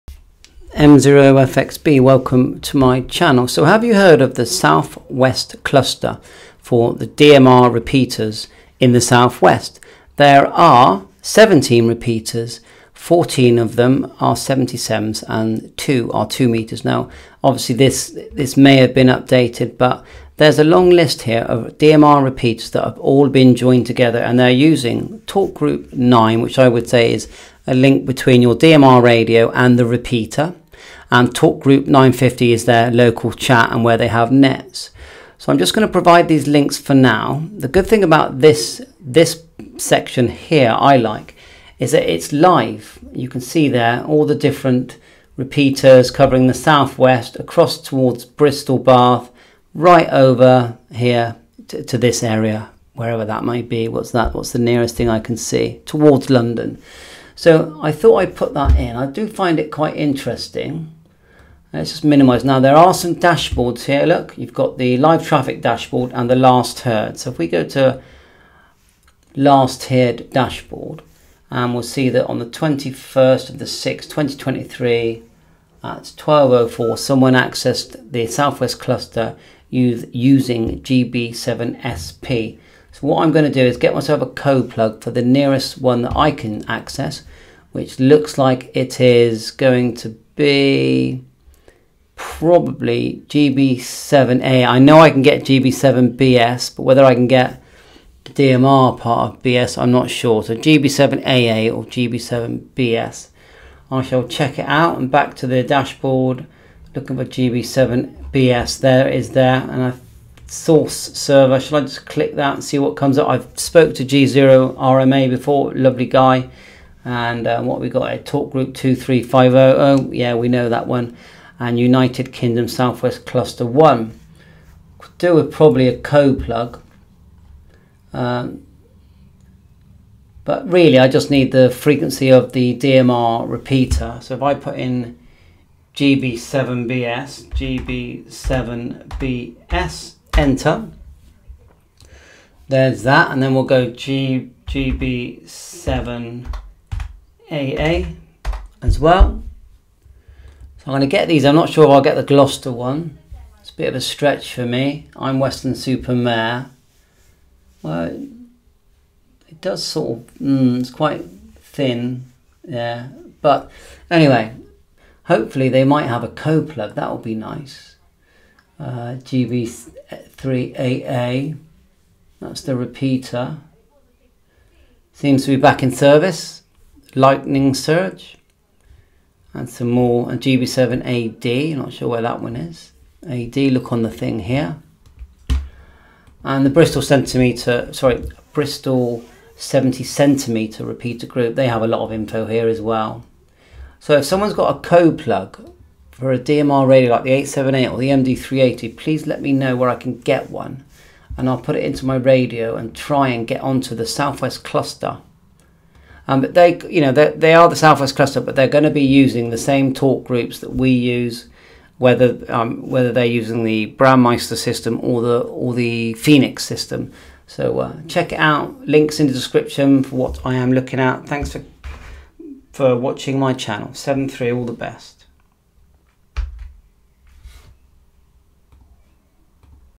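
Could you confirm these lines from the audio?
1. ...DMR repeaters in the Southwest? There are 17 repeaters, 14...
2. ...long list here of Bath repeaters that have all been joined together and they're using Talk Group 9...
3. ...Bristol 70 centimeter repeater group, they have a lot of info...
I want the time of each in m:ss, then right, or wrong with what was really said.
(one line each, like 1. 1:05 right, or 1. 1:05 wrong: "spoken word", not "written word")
1. 0:07 right
2. 0:20 wrong: "DMR", not "Bath"
3. 3:08 right.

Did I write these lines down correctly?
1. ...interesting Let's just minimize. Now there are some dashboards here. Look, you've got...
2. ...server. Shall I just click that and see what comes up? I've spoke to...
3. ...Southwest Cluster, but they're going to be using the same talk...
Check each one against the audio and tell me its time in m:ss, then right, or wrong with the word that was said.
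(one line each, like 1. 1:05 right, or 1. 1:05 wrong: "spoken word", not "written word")
1. 0:59 right
2. 1:51 right
3. 3:27 right.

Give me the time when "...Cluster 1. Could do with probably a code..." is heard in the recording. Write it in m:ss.
2:03.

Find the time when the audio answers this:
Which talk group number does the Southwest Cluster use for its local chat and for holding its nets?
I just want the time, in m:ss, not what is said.
0:31.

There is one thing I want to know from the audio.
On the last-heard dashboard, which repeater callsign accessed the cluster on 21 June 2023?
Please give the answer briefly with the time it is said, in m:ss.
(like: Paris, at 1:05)
GB7SP, at 1:20.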